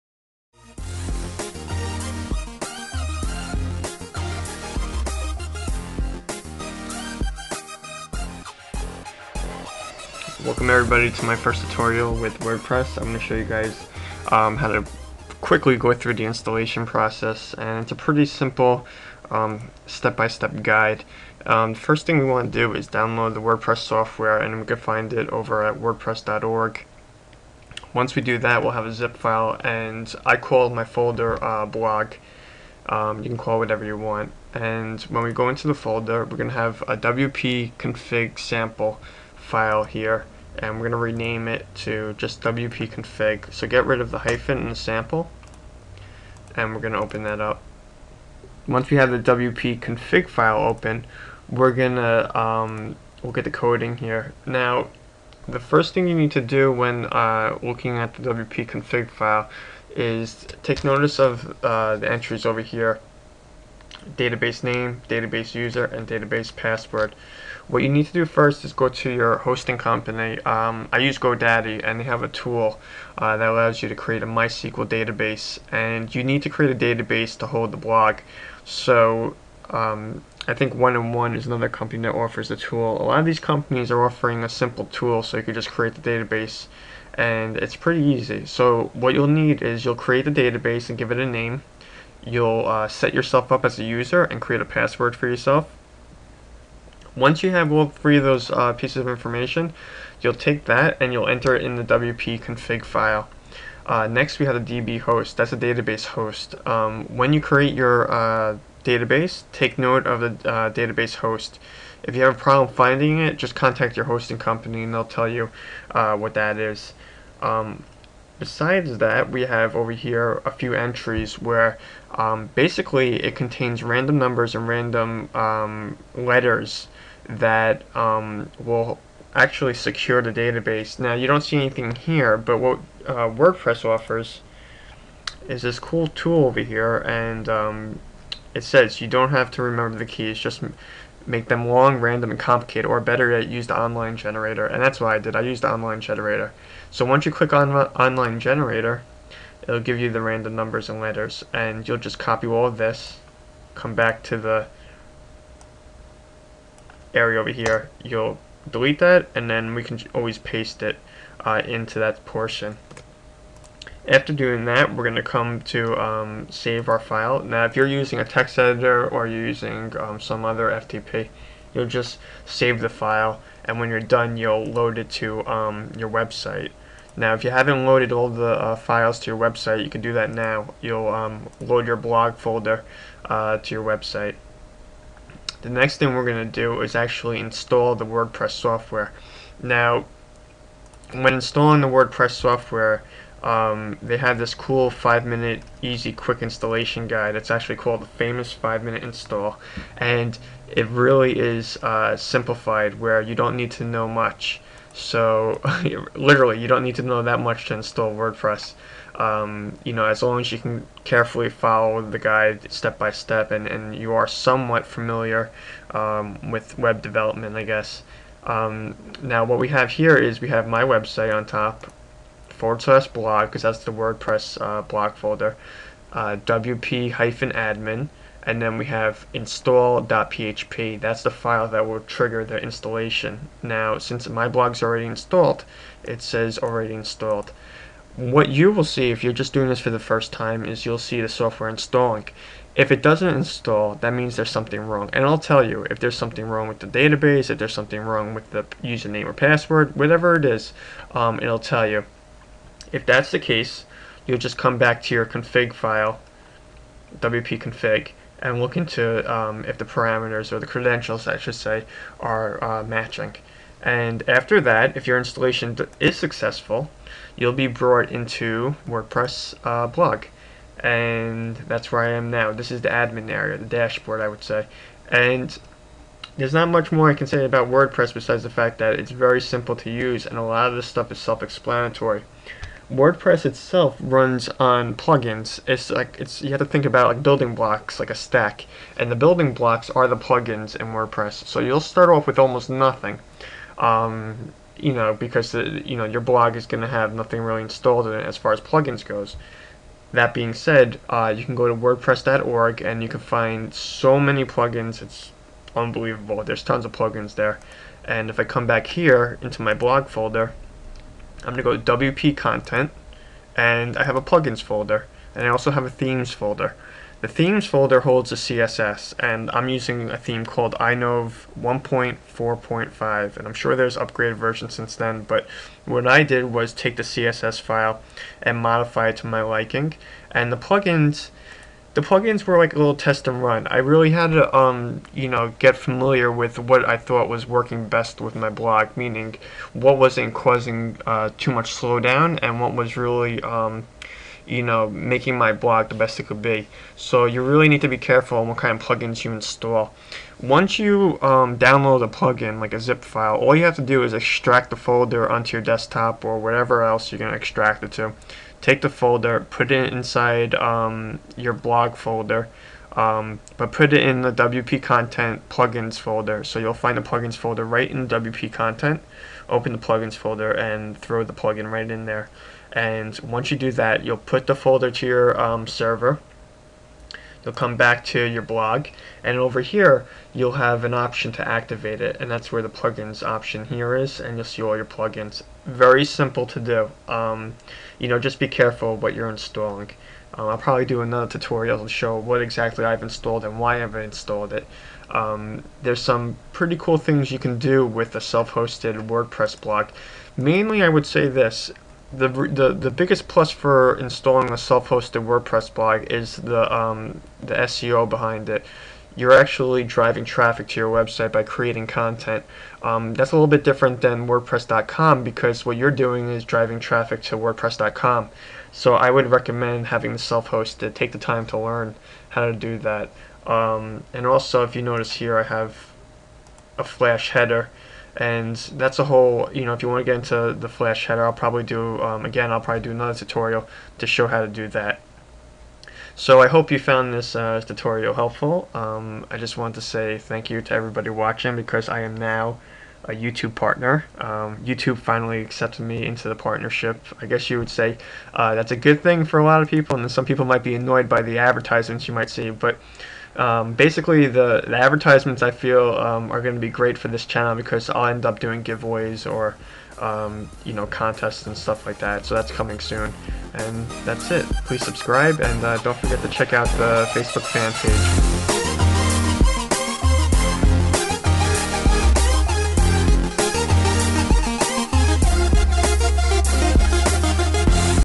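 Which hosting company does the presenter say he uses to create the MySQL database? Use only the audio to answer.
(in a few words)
GoDaddy.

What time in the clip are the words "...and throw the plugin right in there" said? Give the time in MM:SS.
06:10.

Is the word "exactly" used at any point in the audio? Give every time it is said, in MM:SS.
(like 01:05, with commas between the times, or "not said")
06:32.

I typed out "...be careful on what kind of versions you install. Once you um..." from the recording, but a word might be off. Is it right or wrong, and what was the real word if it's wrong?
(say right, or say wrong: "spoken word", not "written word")
wrong: "plugins", not "versions".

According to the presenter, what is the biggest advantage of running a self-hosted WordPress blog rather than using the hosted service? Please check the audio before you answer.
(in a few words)
SEO.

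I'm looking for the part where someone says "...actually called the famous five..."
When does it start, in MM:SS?
03:17.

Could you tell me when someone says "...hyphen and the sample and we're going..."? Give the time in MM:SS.
00:44.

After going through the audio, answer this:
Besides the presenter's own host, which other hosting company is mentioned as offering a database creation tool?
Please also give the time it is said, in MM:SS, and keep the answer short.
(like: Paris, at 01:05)
One on One, at 01:20.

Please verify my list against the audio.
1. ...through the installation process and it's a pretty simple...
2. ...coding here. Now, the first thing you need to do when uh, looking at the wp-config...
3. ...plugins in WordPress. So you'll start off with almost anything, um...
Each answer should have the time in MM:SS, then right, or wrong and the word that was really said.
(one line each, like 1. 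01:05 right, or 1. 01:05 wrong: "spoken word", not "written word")
1. 00:15 right
2. 00:53 right
3. 04:50 wrong: "nothing", not "anything".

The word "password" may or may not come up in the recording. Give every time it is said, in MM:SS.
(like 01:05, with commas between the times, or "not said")
01:06, 01:34, 04:09.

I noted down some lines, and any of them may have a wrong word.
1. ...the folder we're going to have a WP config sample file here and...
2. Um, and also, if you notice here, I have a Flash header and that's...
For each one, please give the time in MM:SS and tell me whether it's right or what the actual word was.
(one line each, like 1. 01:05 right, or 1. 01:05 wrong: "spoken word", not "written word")
1. 00:35 right
2. 07:03 right.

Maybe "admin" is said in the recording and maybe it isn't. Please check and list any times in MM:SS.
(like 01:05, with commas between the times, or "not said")
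03:47, 04:32.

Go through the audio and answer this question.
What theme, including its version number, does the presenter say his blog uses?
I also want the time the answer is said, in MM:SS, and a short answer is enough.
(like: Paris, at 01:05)
iNove 1.4.5, at 05:20.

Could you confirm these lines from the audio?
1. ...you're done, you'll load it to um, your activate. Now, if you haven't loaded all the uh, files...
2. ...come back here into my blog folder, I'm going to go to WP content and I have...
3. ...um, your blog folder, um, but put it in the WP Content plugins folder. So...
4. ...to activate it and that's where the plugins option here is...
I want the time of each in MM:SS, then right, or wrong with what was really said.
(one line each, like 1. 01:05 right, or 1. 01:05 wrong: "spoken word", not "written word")
1. 02:53 wrong: "website", not "activate"
2. 05:08 right
3. 06:00 right
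4. 06:21 right.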